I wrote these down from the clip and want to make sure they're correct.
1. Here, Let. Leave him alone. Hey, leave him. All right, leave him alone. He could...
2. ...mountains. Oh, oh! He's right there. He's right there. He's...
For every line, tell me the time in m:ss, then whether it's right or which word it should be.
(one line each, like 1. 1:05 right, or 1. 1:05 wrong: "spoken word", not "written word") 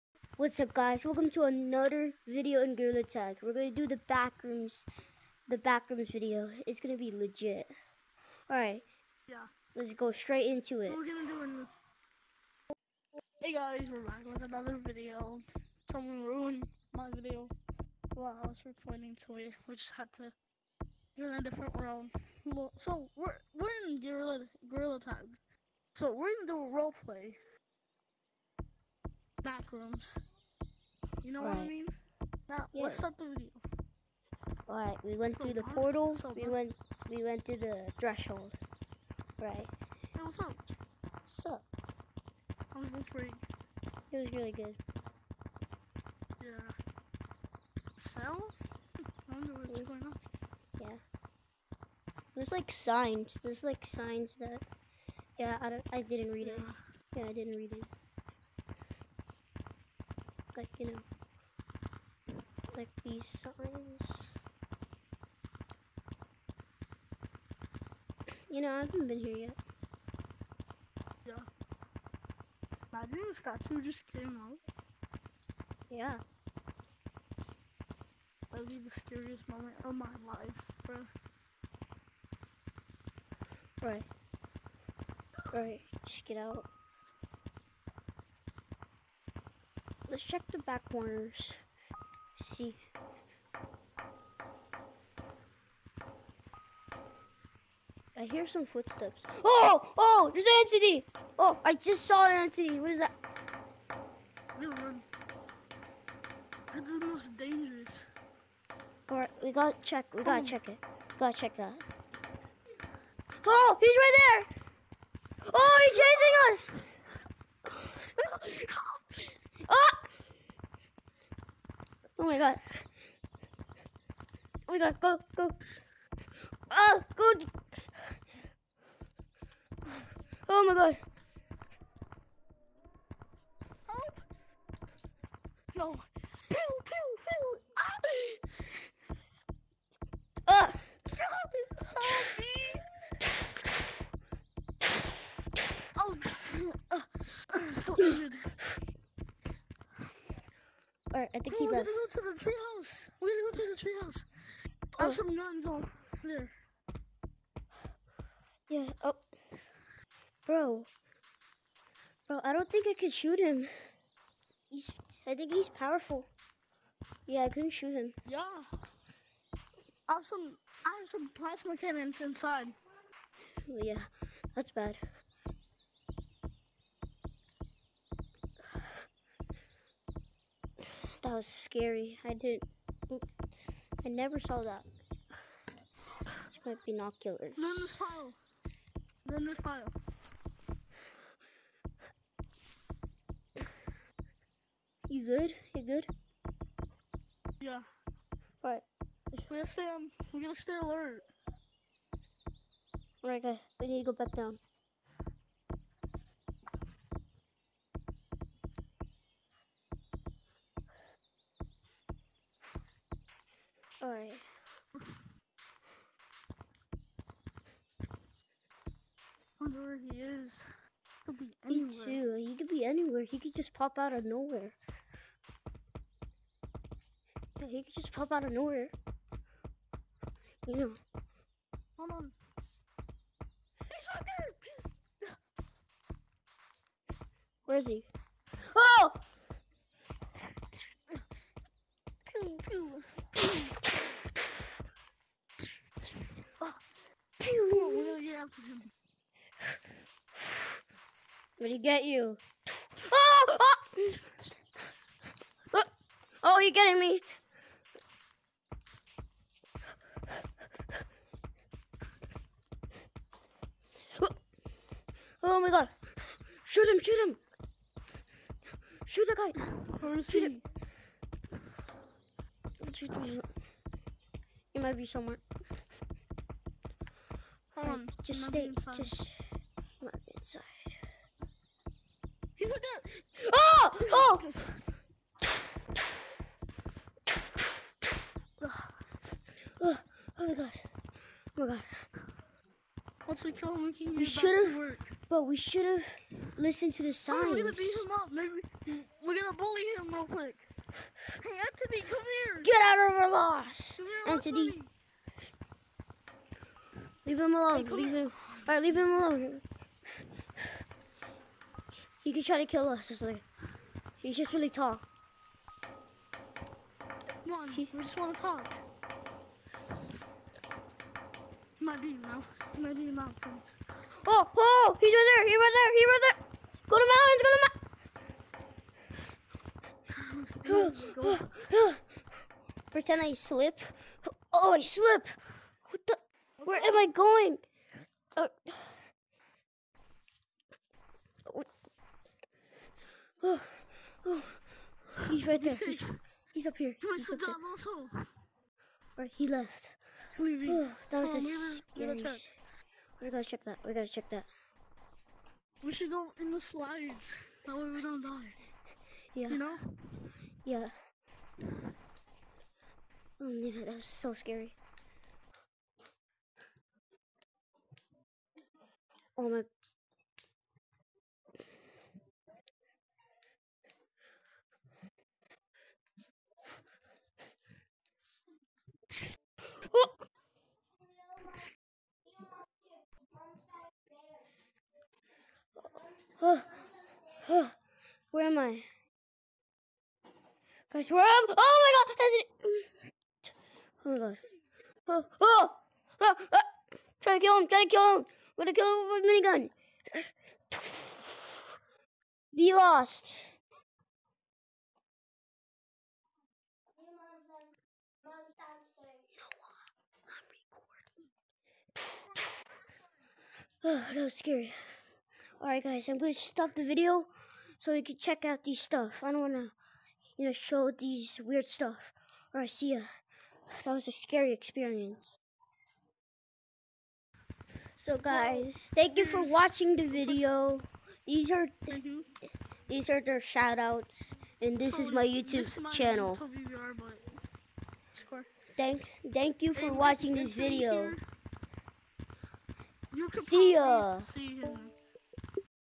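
1. 5:03 wrong: "Anthony", not "Let"
2. 5:23 right.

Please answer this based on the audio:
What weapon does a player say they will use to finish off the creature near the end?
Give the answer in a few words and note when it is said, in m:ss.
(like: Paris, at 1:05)
Minigun, at 6:39.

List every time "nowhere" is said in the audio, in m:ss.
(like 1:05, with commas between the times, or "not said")
3:44, 3:48.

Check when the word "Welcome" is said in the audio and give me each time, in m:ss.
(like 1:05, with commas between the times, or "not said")
0:01.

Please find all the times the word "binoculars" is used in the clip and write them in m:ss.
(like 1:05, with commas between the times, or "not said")
3:06.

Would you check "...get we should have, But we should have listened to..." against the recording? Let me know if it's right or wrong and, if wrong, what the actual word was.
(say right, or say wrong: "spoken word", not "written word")
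right.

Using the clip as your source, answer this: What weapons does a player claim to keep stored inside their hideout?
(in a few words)
Plasma cannons.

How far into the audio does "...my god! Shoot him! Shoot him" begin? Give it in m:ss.
4:25.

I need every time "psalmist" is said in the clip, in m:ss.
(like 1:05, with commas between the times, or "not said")
not said.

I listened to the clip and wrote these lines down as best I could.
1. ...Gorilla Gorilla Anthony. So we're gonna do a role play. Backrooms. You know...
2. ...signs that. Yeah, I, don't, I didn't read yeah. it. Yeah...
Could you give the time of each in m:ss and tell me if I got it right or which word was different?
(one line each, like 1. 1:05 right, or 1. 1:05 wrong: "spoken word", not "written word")
1. 0:24 wrong: "Tag", not "Anthony"
2. 0:53 right.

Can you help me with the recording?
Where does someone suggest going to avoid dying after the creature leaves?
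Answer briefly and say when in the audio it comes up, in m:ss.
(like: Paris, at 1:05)
The slides, at 5:56.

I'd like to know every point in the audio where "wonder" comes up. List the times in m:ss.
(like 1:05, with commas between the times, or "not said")
0:49, 3:39.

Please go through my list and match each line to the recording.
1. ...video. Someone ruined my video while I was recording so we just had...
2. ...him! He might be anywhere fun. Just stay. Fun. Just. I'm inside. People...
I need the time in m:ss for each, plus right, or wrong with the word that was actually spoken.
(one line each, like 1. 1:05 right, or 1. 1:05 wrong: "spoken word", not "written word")
1. 0:14 right
2. 4:33 wrong: "somewhere", not "anywhere".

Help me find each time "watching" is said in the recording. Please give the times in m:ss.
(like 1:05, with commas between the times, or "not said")
7:09, 7:20.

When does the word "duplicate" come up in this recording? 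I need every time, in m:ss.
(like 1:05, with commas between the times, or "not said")
not said.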